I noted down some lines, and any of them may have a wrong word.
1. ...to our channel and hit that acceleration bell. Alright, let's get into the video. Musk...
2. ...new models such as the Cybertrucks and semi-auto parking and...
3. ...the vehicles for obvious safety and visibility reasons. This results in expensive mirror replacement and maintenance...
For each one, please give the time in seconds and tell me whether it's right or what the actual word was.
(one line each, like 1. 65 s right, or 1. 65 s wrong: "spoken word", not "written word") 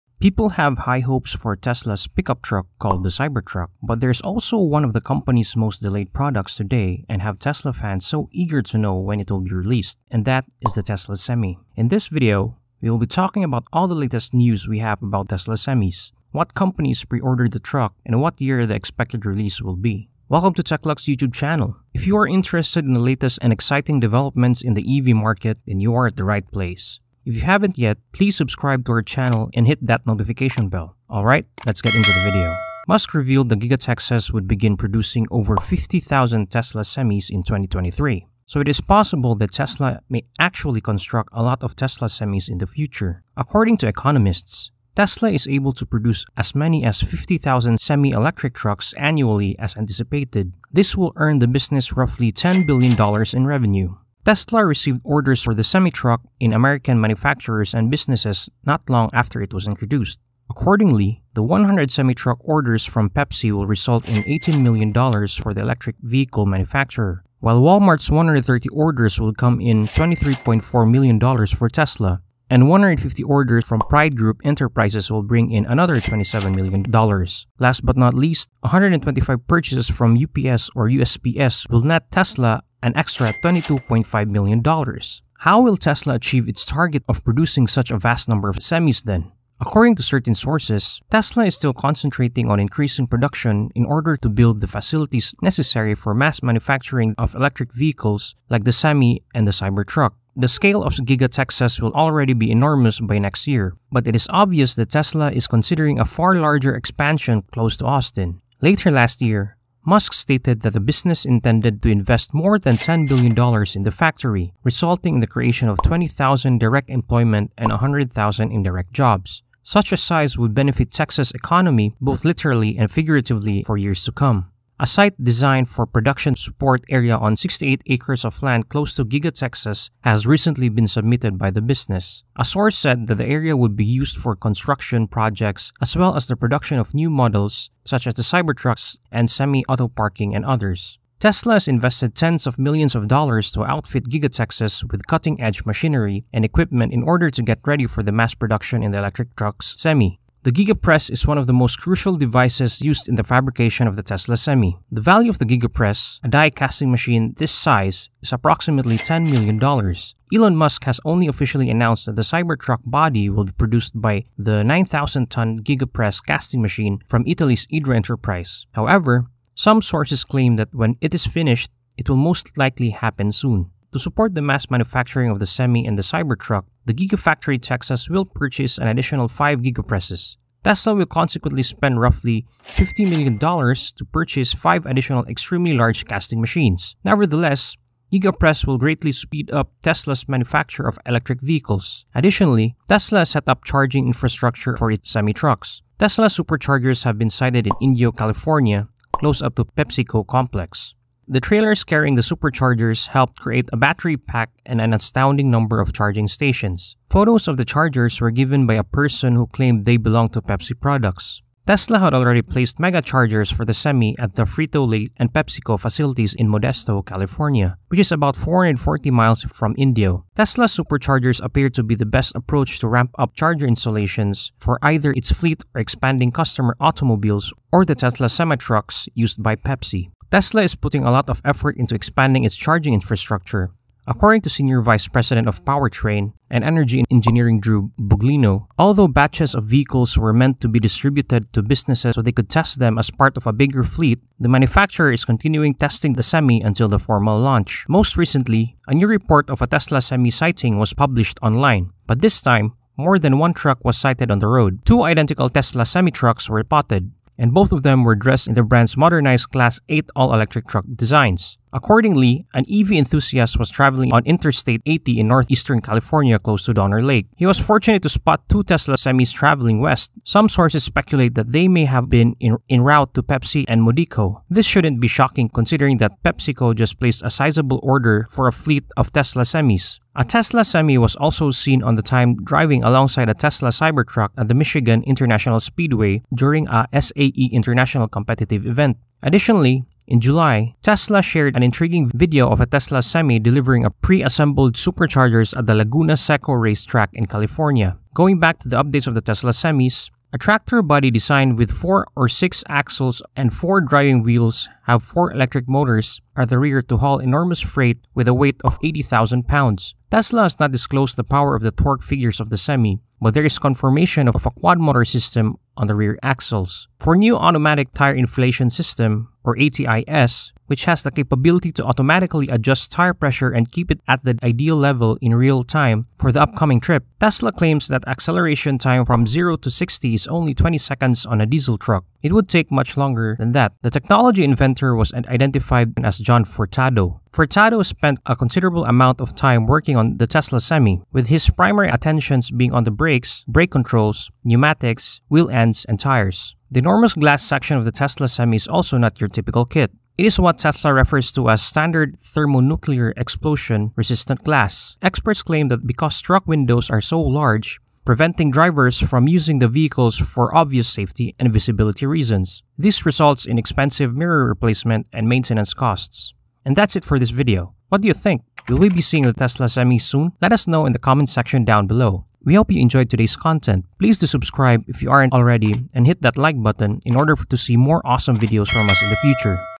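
1. 28 s wrong: "notification", not "acceleration"
2. 136 s right
3. 359 s right.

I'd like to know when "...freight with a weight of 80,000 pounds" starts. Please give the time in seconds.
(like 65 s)
307 s.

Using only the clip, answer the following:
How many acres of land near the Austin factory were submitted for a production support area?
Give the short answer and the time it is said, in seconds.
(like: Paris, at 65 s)
68, at 127 s.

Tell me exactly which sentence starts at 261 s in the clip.
Accordingly, an EV enthusiast was traveling on Interstate 80 in northeastern California close to Donner Lake.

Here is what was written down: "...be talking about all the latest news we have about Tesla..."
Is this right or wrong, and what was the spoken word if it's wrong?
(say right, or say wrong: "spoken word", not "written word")
right.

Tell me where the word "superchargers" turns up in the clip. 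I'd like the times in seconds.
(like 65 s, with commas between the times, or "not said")
196 s, 202 s, 220 s, 294 s.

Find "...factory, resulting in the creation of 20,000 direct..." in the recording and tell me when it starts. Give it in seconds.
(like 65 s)
113 s.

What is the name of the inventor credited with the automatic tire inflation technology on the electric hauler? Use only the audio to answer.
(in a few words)
John Furtado.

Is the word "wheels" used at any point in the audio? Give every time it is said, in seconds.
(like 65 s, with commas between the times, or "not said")
304 s, 345 s.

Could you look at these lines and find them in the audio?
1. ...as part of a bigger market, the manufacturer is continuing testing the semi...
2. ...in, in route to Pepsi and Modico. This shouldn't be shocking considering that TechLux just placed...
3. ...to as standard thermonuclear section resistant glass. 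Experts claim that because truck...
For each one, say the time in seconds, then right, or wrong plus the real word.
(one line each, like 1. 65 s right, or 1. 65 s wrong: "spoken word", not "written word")
1. 242 s wrong: "fleet", not "market"
2. 272 s wrong: "PepsiCo", not "TechLux"
3. 351 s wrong: "explosion", not "section".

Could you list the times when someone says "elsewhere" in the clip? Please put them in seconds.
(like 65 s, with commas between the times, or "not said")
not said.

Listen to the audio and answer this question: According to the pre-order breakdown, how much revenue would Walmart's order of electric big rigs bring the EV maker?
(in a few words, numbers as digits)
$23.4 million.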